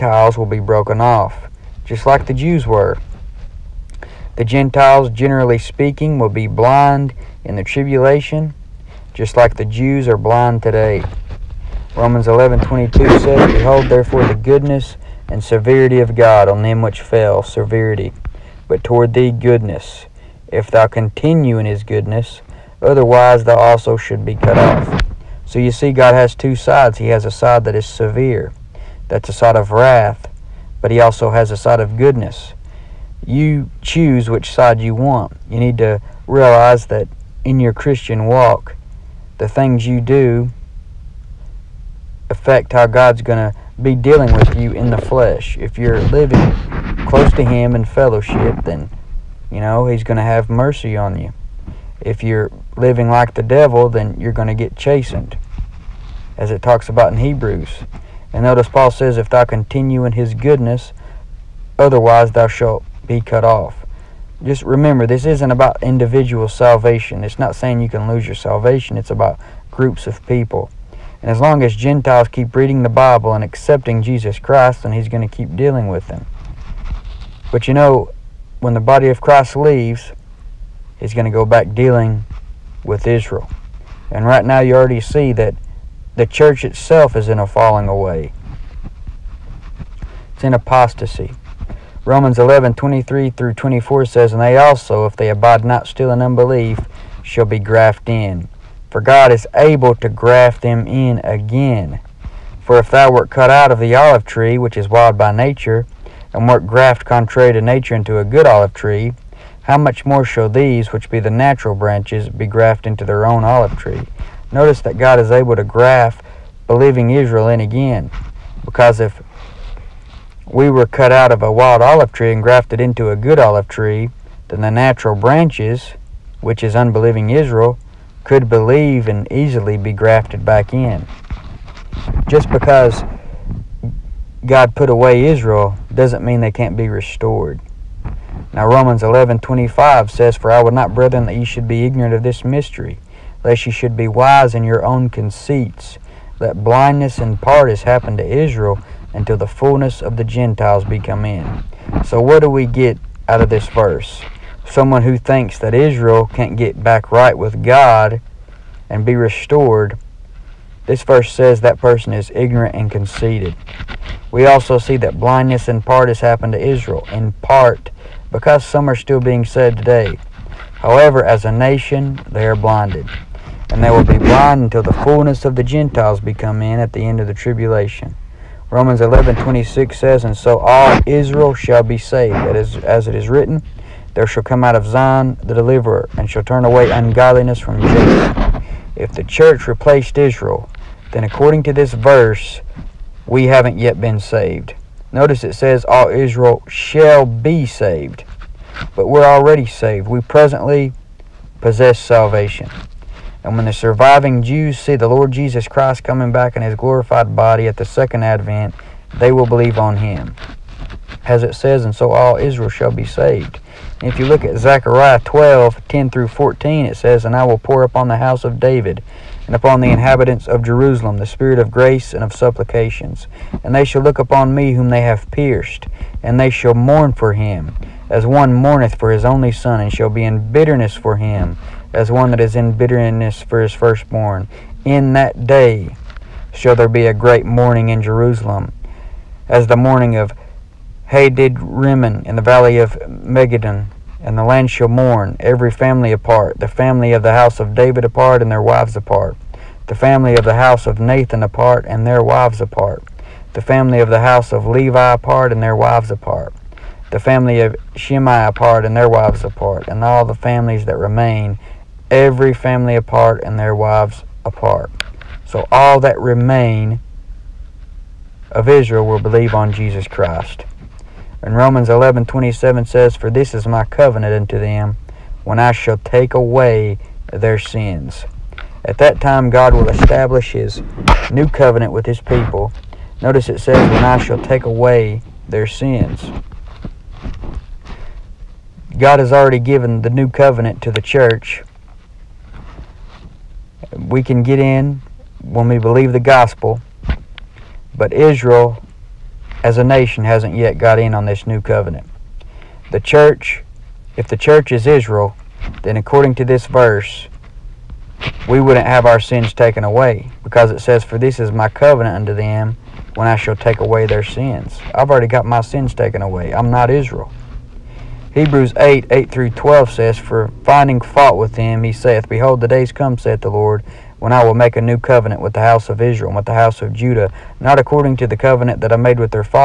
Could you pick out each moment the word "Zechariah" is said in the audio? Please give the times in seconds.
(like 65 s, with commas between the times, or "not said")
214 s.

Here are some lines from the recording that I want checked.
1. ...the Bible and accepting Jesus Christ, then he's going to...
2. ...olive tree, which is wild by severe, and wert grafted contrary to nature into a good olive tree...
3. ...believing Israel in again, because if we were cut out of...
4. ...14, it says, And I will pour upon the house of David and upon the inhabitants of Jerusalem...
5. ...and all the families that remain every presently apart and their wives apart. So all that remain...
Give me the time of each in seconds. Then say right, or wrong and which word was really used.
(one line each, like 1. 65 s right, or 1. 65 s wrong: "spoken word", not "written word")
1. 72 s right
2. 103 s wrong: "nature", not "severe"
3. 116 s right
4. 216 s right
5. 259 s wrong: "family", not "presently".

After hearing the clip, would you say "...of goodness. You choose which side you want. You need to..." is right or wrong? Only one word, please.
right.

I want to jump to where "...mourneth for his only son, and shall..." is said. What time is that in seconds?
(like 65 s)
228 s.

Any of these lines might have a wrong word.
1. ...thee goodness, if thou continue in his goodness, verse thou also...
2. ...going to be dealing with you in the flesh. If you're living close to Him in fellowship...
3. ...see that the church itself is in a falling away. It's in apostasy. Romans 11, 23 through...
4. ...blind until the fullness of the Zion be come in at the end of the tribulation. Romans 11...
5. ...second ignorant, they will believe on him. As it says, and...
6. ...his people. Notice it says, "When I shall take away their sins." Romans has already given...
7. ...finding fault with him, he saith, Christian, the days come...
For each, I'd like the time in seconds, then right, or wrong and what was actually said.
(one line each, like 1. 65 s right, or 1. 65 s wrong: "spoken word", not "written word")
1. 19 s wrong: "otherwise", not "verse"
2. 43 s right
3. 84 s right
4. 174 s wrong: "Gentiles", not "Zion"
5. 207 s wrong: "advent", not "ignorant"
6. 282 s wrong: "God", not "Romans"
7. 320 s wrong: "Behold", not "Christian".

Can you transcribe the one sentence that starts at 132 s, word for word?
Just because God put away Israel doesn't mean they can't be restored.